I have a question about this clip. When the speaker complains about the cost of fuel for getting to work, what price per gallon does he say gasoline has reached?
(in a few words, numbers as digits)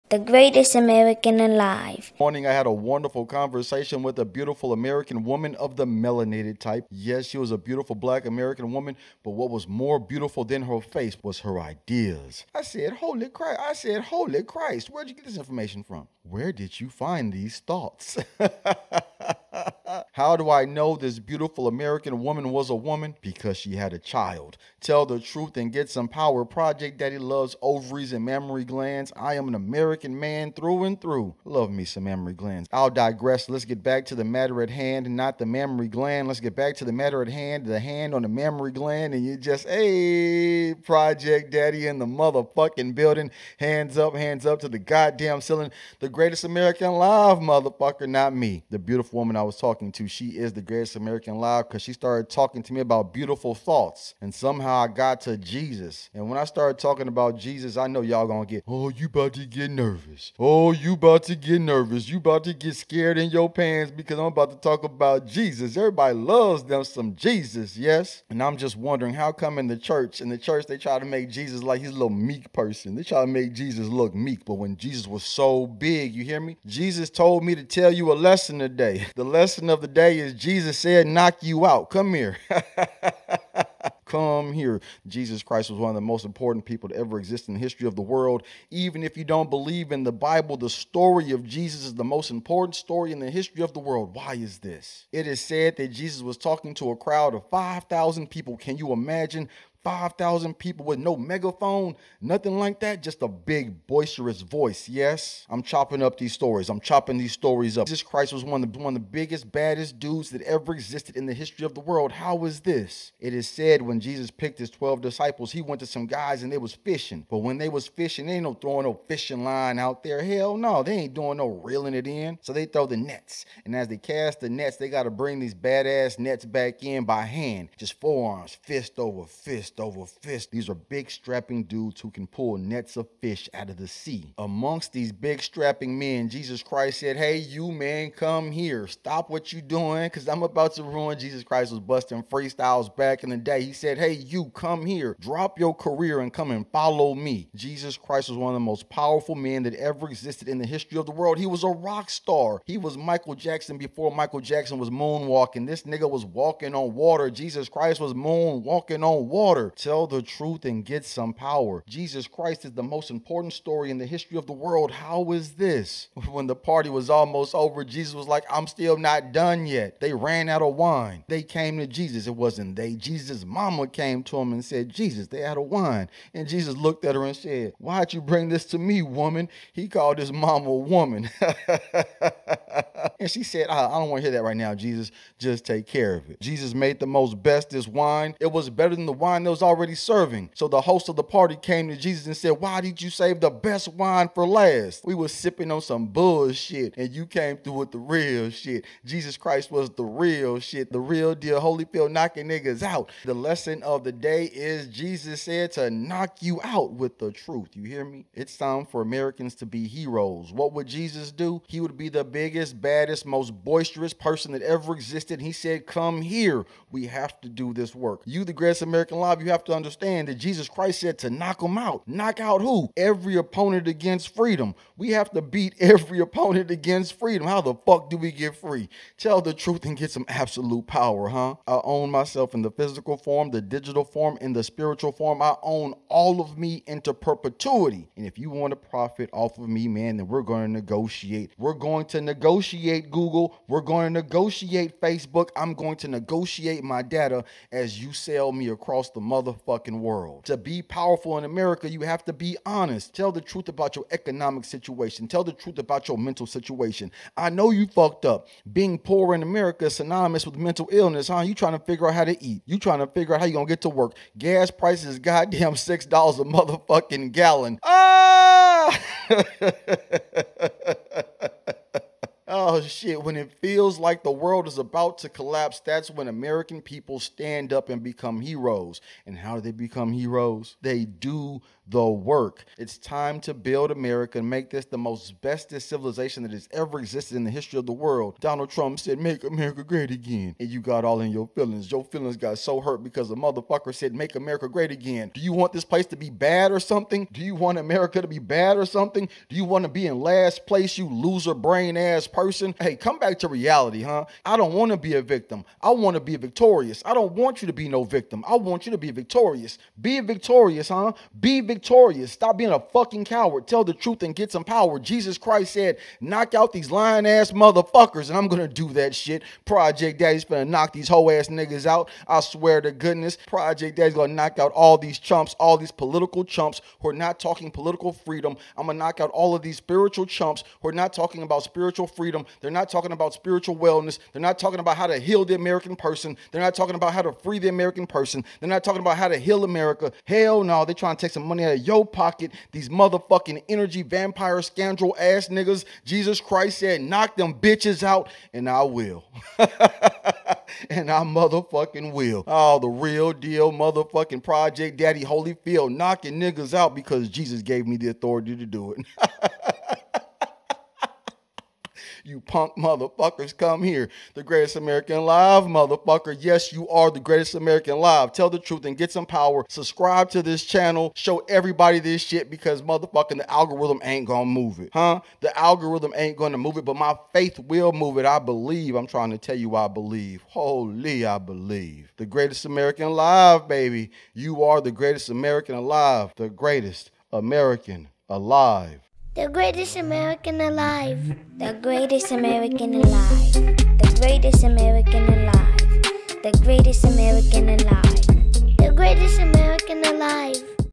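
$6.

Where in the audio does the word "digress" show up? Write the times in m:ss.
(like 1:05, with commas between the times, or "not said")
0:32.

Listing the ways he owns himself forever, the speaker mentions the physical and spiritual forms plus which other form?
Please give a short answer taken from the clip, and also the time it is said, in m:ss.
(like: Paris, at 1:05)
Digital, at 3:53.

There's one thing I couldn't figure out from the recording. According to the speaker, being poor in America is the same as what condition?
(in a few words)
Mental illness.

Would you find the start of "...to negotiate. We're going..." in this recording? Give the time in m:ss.
4:00.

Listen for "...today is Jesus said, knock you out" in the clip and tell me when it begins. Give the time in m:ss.
1:20.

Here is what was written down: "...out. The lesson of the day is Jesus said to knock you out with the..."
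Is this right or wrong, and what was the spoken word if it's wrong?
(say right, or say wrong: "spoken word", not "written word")
right.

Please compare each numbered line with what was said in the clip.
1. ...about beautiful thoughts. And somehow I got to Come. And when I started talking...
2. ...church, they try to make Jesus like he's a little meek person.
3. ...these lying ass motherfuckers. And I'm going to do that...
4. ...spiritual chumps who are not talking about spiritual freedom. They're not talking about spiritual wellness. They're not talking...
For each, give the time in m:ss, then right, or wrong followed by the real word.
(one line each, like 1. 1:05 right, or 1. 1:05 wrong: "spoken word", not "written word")
1. 0:52 wrong: "Jesus", not "Come"
2. 1:10 right
3. 5:16 right
4. 5:29 right.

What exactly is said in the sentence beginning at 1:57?
But when they was fishing, they ain't no throwing no fishing line out there.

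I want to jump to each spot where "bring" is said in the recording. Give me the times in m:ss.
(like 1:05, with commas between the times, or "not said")
2:05, 2:58.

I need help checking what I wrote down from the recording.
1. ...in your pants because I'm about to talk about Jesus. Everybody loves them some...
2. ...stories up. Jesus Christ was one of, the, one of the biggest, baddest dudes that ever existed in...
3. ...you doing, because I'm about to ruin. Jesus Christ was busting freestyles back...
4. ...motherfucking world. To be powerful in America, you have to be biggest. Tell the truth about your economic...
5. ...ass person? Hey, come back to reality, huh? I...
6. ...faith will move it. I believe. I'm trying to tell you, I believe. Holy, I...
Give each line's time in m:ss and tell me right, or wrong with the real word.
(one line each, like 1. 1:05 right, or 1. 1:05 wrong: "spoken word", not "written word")
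1. 1:03 right
2. 1:47 right
3. 2:19 right
4. 4:09 wrong: "honest", not "biggest"
5. 5:01 right
6. 6:17 right.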